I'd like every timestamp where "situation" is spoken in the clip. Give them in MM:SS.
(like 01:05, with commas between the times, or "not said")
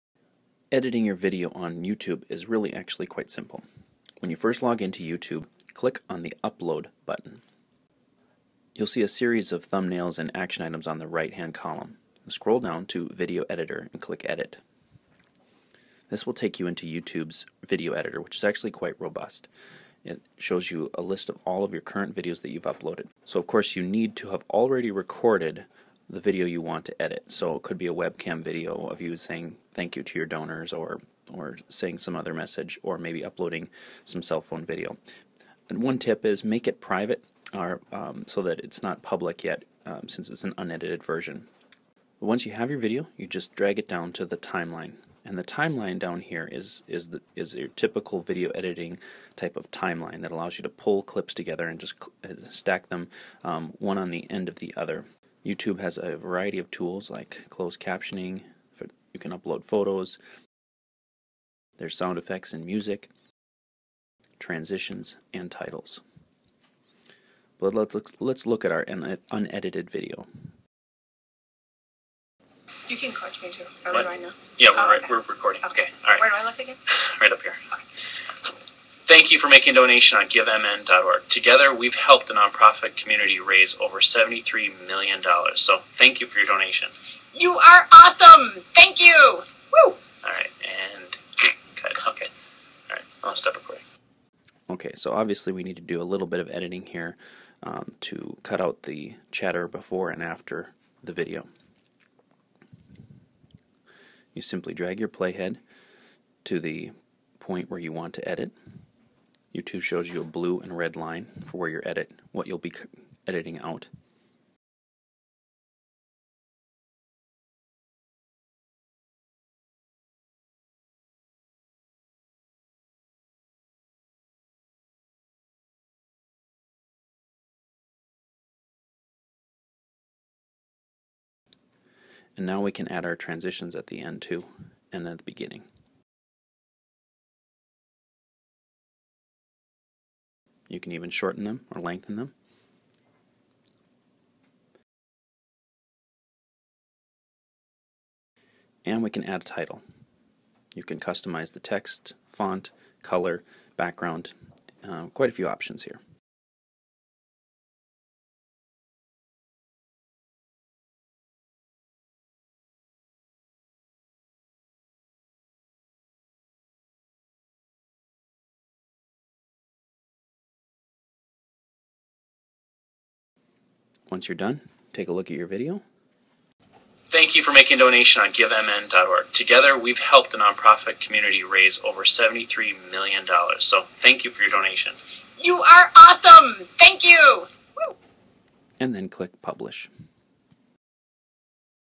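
not said.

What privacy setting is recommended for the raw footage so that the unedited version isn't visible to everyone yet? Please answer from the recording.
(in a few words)
Private.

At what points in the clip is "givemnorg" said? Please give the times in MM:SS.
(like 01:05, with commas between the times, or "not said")
01:20, 02:58.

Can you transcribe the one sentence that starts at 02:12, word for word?
And now we can add our transitions at the end too, and at the beginning.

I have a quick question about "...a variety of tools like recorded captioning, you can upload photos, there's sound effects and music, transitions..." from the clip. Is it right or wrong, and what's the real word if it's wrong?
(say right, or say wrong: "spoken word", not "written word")
wrong: "closed", not "recorded".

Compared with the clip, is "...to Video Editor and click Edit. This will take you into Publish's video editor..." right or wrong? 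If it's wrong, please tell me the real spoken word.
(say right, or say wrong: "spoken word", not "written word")
wrong: "YouTube", not "Publish".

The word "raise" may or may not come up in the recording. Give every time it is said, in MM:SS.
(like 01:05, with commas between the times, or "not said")
01:23, 03:01.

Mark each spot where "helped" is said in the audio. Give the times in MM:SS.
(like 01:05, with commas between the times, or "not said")
01:21, 02:59.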